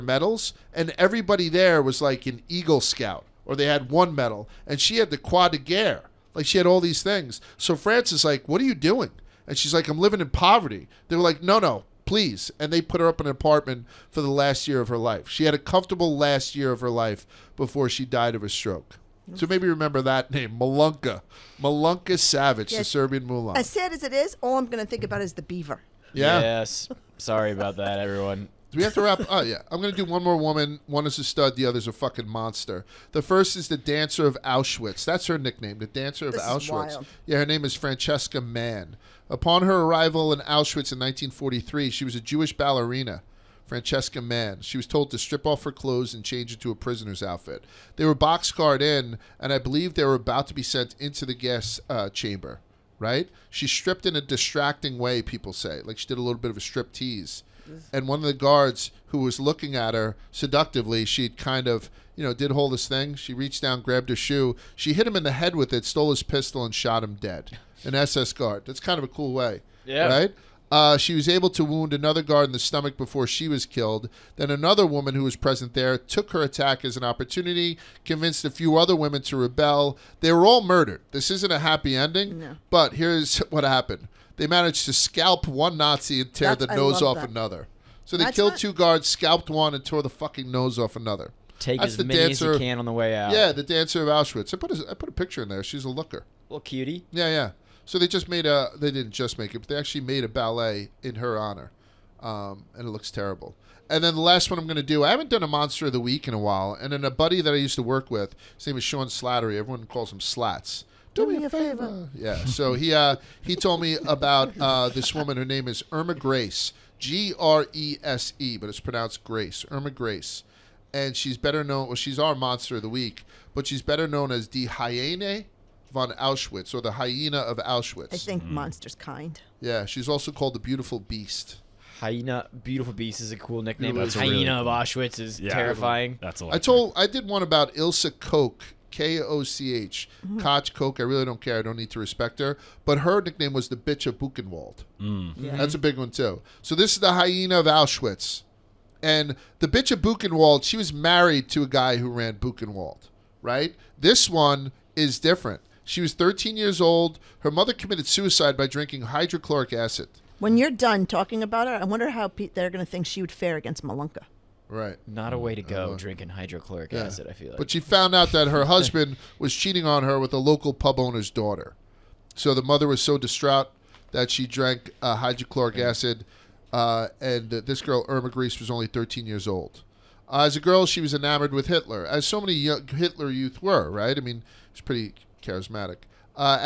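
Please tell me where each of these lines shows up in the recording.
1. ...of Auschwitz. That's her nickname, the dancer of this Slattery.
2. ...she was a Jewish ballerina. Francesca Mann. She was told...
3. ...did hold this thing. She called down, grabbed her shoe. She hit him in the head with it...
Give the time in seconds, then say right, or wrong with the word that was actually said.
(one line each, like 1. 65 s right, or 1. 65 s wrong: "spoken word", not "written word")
1. 34 s wrong: "Auschwitz", not "Slattery"
2. 41 s right
3. 62 s wrong: "reached", not "called".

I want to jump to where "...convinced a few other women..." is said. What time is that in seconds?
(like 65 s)
78 s.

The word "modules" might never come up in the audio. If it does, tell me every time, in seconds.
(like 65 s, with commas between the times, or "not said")
not said.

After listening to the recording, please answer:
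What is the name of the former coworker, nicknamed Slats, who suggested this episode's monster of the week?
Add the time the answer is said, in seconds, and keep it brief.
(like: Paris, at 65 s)
Sean Slattery, at 108 s.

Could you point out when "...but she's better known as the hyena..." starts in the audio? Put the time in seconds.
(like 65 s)
123 s.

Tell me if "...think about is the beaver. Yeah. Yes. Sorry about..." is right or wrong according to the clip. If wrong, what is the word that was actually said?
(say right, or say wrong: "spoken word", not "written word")
right.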